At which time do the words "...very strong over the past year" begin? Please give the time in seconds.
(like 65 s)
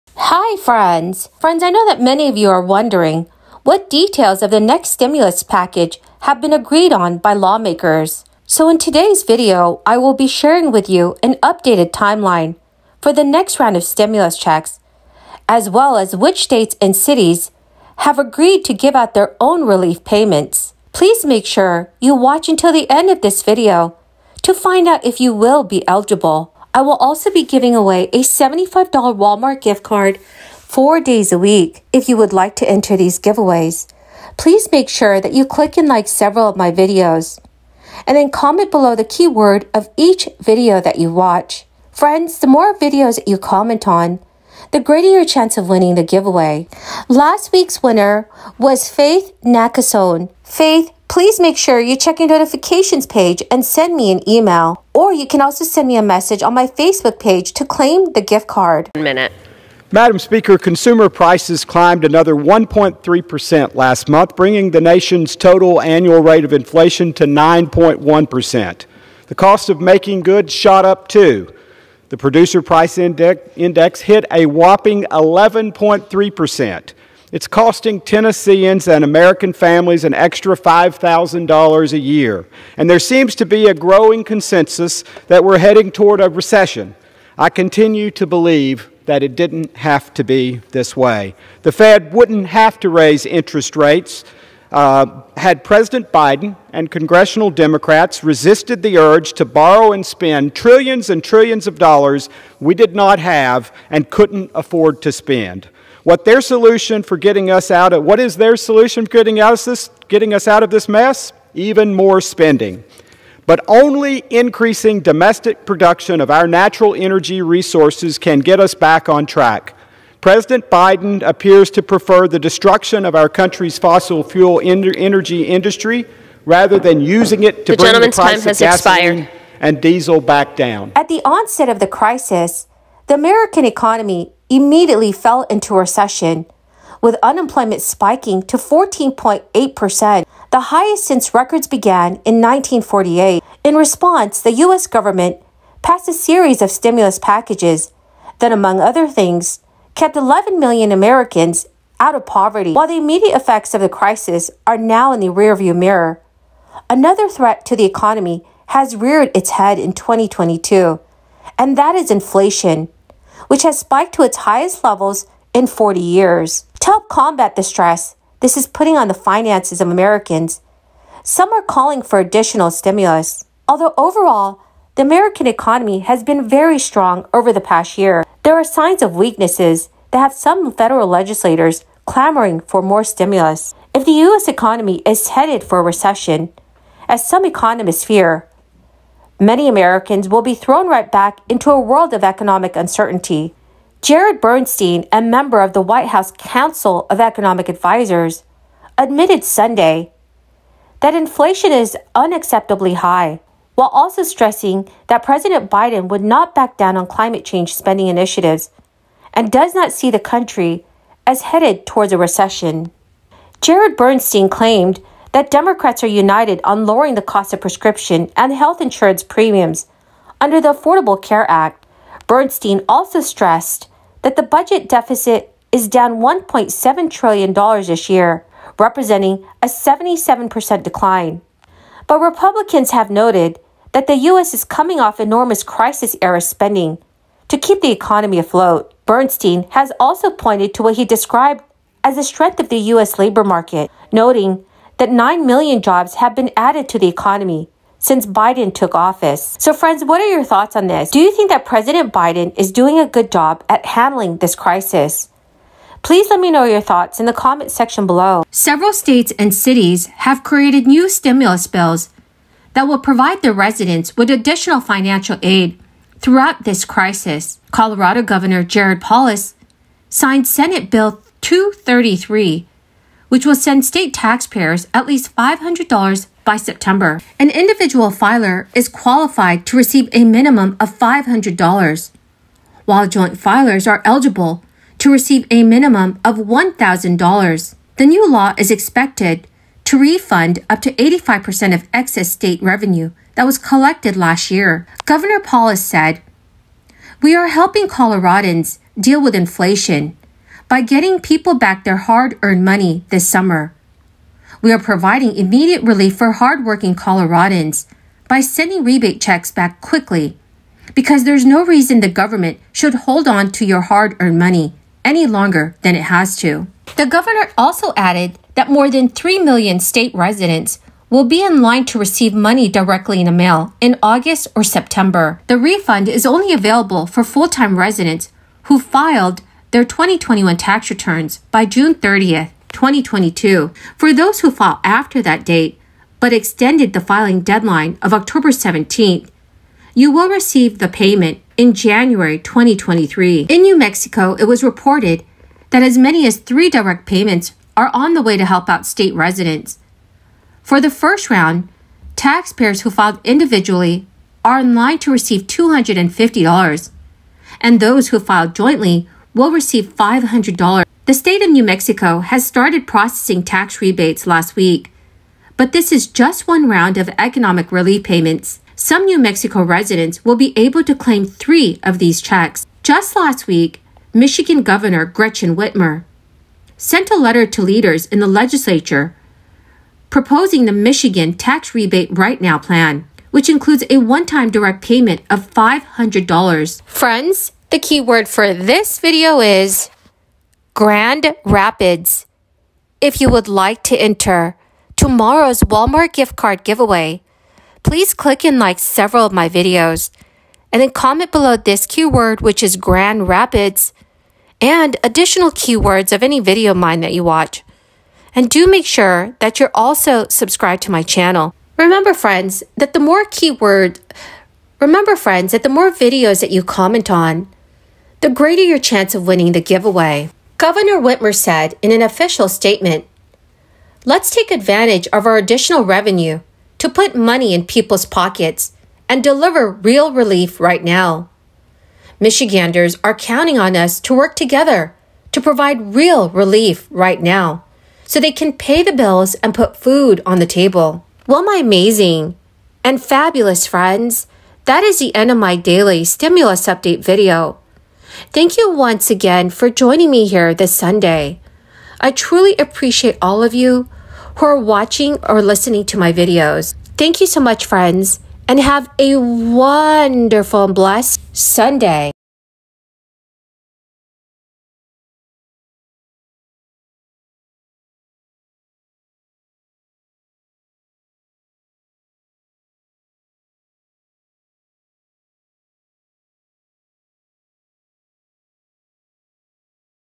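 176 s.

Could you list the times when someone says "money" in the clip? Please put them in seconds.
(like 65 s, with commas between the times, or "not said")
302 s, 314 s, 322 s, 427 s.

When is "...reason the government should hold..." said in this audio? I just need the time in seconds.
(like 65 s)
311 s.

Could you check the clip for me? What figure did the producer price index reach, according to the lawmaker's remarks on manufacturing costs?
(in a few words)
11.3%.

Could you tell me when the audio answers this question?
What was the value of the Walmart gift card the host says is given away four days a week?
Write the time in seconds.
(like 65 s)
28 s.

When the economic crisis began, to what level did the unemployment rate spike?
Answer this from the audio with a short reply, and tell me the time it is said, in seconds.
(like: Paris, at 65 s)
14.8%, at 138 s.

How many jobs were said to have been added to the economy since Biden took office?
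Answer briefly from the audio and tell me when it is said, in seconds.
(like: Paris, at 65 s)
9 million, at 245 s.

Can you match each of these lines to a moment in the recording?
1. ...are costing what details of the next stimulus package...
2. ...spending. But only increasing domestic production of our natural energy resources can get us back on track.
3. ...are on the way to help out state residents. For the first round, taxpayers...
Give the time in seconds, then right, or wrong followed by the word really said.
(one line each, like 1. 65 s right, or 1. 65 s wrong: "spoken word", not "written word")
1. 2 s wrong: "wondering", not "costing"
2. 112 s right
3. 347 s right.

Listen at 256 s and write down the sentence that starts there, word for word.
Please let me know your thoughts in the comment section below.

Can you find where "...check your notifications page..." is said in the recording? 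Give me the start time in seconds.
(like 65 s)
51 s.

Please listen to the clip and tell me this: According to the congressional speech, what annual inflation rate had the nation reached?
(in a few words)
9.1%.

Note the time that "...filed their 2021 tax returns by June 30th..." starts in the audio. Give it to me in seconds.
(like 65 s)
328 s.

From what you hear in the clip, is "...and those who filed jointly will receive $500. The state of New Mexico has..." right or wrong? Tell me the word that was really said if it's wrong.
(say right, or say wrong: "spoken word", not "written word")
right.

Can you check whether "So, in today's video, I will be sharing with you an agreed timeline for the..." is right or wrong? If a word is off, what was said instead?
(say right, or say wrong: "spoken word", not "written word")
wrong: "updated", not "agreed".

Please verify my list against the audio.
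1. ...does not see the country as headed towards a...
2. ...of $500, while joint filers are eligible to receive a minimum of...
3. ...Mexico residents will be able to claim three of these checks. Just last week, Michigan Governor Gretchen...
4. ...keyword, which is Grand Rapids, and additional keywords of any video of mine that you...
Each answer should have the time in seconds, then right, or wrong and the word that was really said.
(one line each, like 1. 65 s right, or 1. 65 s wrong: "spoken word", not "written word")
1. 209 s right
2. 280 s right
3. 369 s right
4. 401 s right.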